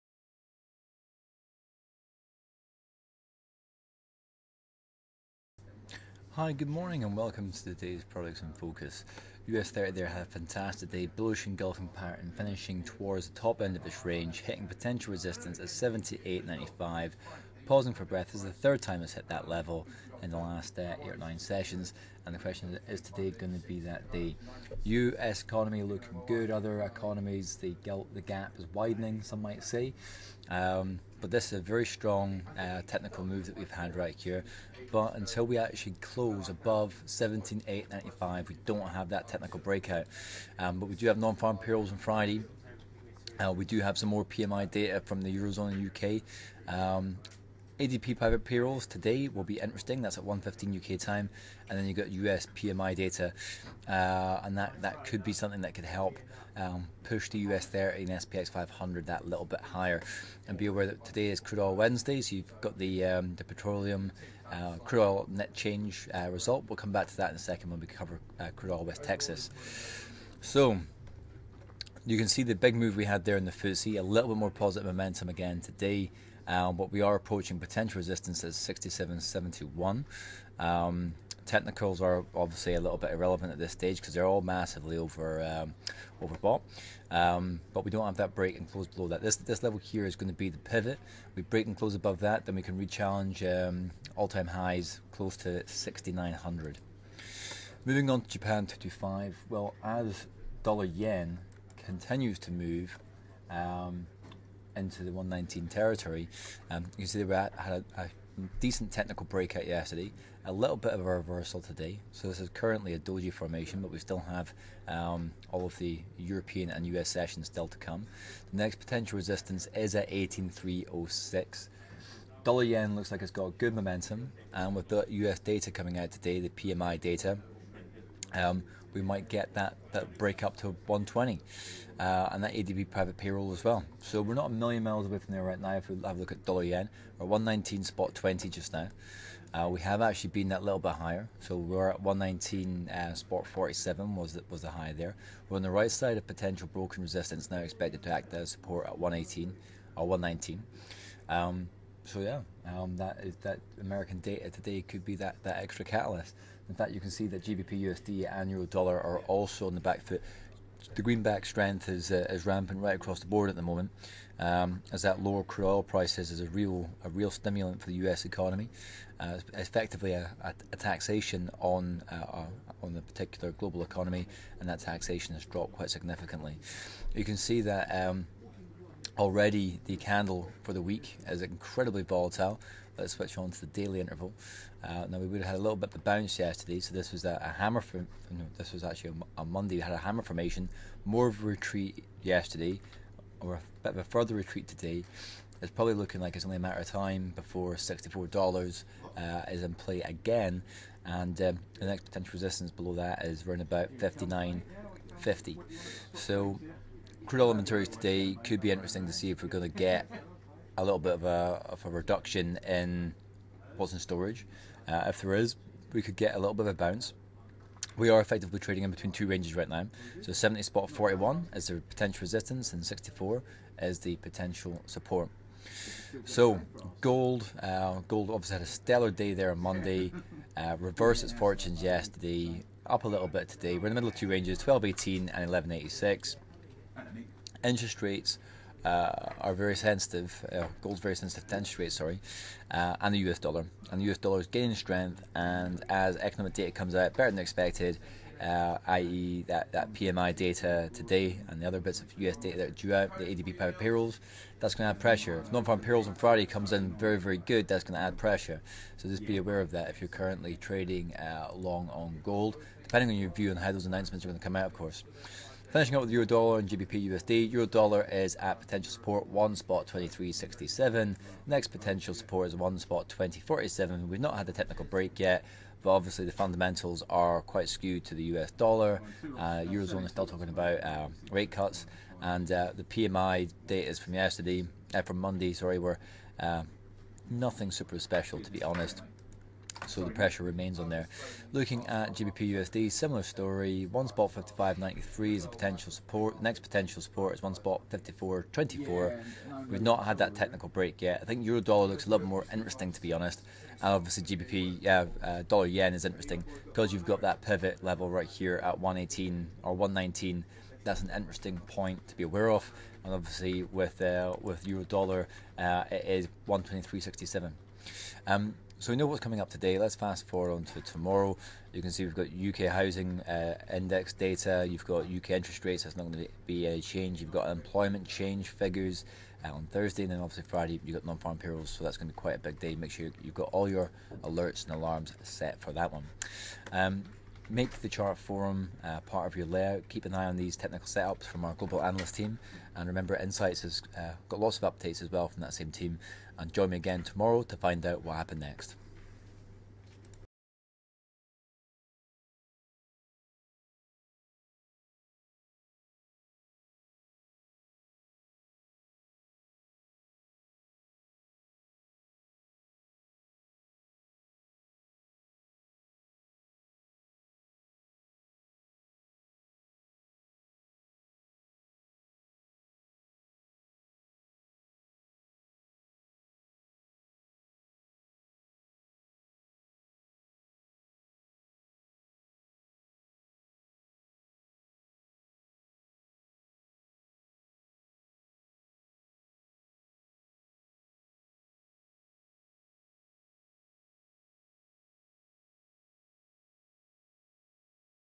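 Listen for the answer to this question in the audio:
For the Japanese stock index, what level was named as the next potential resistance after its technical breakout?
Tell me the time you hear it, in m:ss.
2:00.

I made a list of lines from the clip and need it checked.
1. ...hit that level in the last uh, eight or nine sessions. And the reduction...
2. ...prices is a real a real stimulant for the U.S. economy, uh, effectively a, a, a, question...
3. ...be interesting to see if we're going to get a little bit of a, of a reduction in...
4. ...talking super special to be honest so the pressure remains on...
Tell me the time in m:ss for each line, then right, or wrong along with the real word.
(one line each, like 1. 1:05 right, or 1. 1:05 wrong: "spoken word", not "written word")
1. 0:19 wrong: "question", not "reduction"
2. 2:45 wrong: "taxation", not "question"
3. 3:28 right
4. 4:47 wrong: "nothing", not "talking".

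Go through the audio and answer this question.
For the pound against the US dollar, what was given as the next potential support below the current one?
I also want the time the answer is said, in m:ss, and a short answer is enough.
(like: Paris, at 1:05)
1.5424, at 4:57.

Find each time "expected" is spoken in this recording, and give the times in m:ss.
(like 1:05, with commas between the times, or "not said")
2:27, 4:07.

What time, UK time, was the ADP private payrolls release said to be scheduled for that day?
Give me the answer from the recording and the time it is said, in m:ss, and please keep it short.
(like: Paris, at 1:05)
1:15, at 0:50.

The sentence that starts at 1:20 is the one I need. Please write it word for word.
Um, technicals are obviously a little bit irrelevant at this stage because they're all massively over um, overbought.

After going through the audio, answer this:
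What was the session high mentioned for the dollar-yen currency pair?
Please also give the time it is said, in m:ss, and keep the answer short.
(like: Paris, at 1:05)
119.47, at 2:22.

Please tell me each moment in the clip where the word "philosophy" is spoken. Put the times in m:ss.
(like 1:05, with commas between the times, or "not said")
not said.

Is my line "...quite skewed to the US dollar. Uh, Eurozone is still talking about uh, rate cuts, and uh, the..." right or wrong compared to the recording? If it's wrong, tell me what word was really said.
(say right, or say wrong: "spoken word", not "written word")
right.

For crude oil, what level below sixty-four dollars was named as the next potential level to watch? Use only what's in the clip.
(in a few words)
59.50.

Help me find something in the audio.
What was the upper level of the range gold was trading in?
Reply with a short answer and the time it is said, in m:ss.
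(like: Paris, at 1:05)
1218, at 3:54.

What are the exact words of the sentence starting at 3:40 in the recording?
So 70 spot 41 is the potential resistance, and 64 is the potential support.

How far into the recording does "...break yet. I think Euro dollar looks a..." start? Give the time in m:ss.
5:00.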